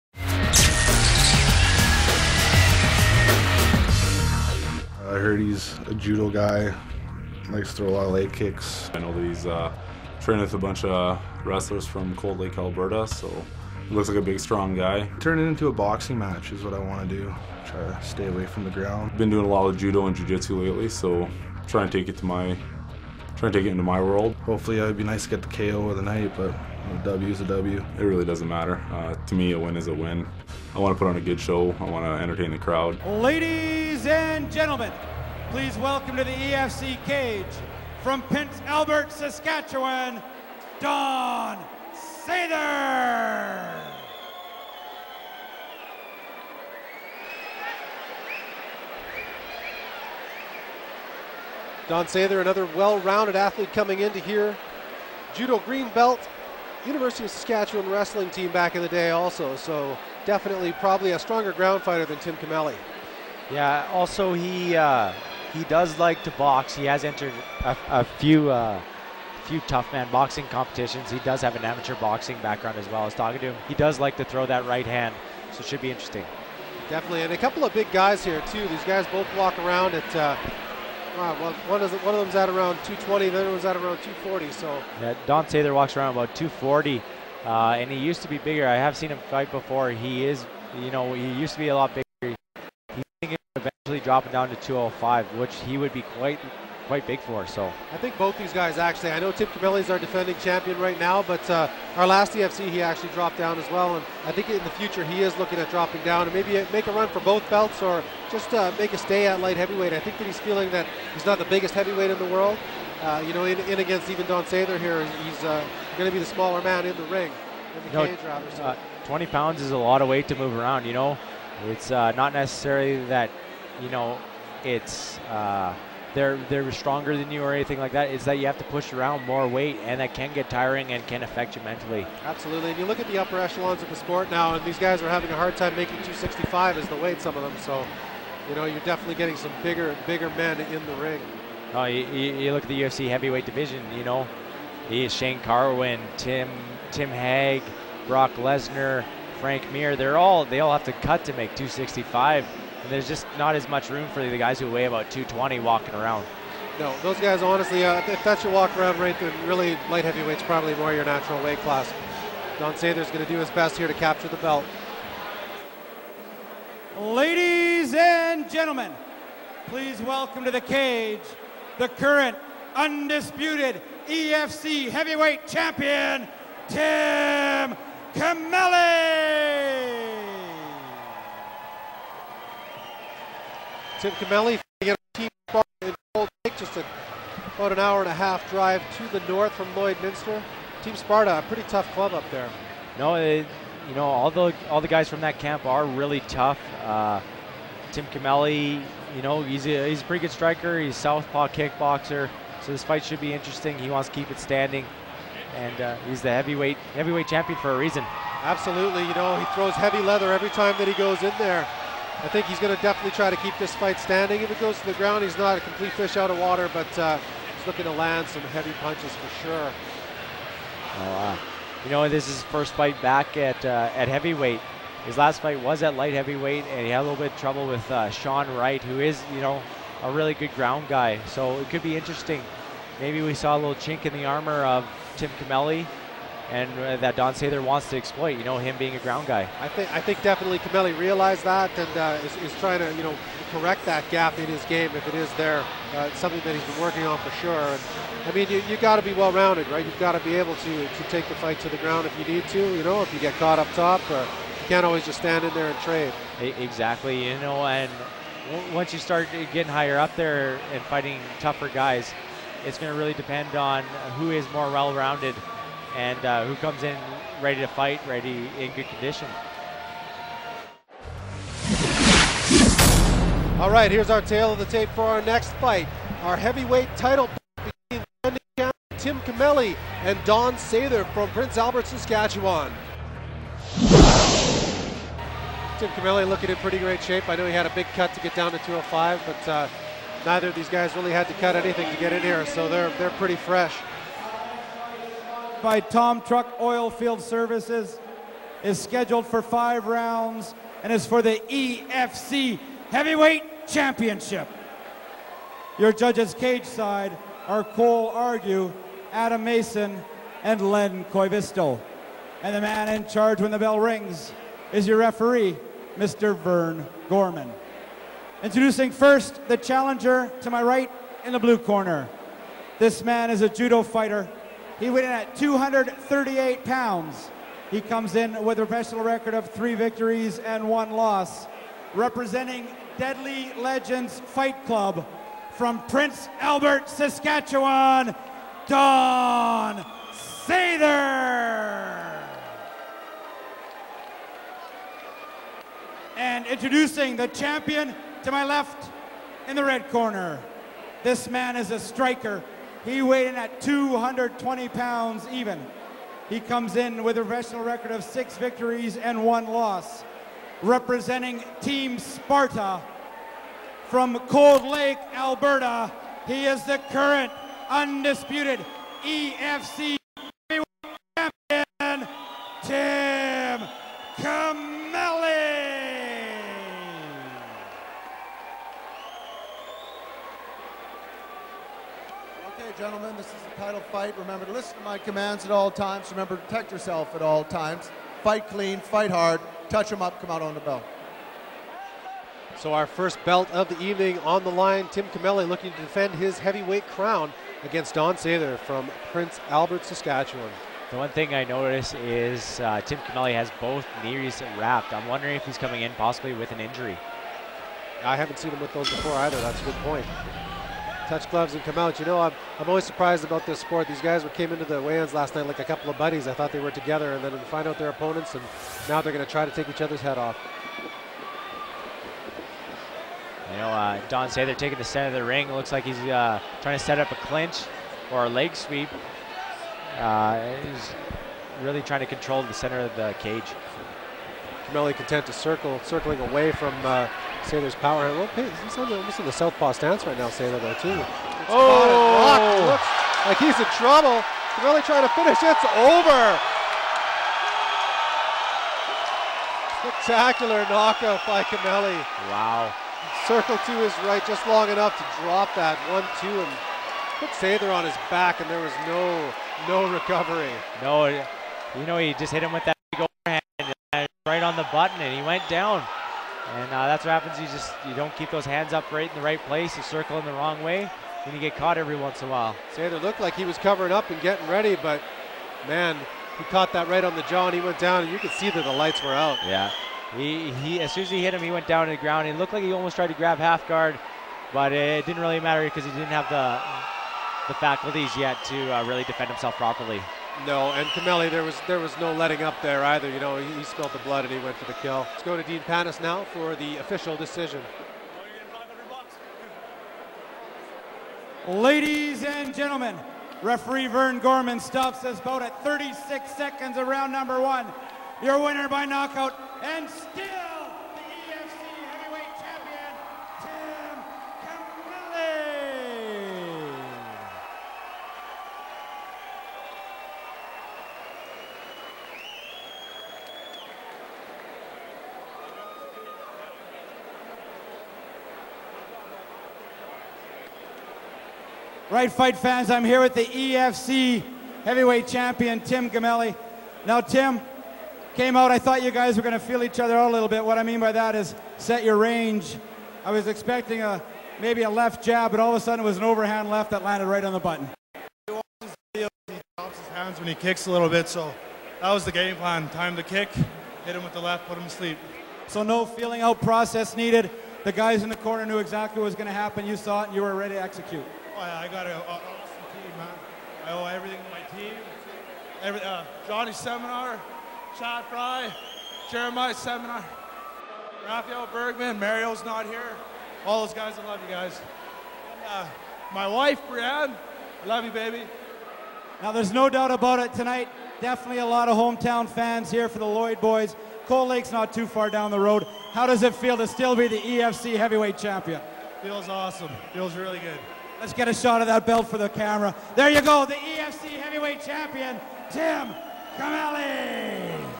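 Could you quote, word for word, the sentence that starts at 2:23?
You know, Shane Carwin, Tim Tim Hague, Brock Lesnar, Frank Mir.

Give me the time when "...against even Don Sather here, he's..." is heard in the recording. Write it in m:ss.
1:53.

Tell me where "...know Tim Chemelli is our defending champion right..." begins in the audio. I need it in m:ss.
1:39.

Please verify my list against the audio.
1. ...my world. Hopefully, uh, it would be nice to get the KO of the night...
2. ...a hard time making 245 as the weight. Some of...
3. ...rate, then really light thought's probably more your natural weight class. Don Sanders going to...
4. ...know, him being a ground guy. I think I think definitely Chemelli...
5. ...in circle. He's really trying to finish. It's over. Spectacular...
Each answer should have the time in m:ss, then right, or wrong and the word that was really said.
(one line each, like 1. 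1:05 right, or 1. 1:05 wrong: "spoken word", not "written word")
1. 0:23 right
2. 2:15 wrong: "265", not "245"
3. 2:38 wrong: "heavyweight", not "thought"
4. 3:58 right
5. 7:23 wrong: "trouble", not "circle".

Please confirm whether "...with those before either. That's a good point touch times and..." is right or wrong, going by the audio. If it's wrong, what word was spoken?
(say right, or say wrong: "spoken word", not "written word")
wrong: "gloves", not "times".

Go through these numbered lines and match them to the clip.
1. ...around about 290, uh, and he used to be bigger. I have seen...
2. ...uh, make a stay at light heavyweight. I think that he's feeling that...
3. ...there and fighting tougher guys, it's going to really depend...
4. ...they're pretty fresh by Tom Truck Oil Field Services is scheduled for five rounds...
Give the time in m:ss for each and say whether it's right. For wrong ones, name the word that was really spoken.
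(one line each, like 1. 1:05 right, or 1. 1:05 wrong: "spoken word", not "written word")
1. 1:25 wrong: "240", not "290"
2. 1:48 right
3. 4:20 right
4. 4:52 right.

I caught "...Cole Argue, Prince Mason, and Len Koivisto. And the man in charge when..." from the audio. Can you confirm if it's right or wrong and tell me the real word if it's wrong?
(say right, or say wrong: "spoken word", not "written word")
wrong: "Adam", not "Prince".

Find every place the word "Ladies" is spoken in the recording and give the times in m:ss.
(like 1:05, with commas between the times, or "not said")
0:33, 2:46, 8:21.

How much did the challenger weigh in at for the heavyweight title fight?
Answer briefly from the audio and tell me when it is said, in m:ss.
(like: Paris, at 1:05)
238 pounds, at 5:25.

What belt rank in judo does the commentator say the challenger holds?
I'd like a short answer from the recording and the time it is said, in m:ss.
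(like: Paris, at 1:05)
Green belt, at 0:55.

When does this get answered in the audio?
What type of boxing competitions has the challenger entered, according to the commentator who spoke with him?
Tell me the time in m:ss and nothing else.
1:09.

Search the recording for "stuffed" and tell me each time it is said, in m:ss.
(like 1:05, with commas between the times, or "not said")
not said.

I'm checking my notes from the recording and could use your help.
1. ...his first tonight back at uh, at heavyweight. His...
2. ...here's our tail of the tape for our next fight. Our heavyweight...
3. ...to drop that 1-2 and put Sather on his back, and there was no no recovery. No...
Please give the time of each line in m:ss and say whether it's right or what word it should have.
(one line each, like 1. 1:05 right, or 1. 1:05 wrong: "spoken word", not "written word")
1. 3:42 wrong: "fight", not "tonight"
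2. 4:33 right
3. 7:34 right.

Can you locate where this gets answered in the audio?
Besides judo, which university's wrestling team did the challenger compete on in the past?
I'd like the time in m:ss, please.
0:56.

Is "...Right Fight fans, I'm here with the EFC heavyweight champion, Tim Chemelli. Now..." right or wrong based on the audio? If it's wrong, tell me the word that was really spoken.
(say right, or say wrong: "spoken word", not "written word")
right.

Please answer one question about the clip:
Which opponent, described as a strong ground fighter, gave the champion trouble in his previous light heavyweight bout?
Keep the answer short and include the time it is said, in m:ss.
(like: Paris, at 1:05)
Sean Wright, at 3:48.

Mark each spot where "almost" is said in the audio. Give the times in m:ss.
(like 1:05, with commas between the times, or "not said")
7:18, 8:02.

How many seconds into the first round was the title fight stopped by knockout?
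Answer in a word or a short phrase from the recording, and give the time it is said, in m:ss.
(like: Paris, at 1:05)
36 seconds, at 8:25.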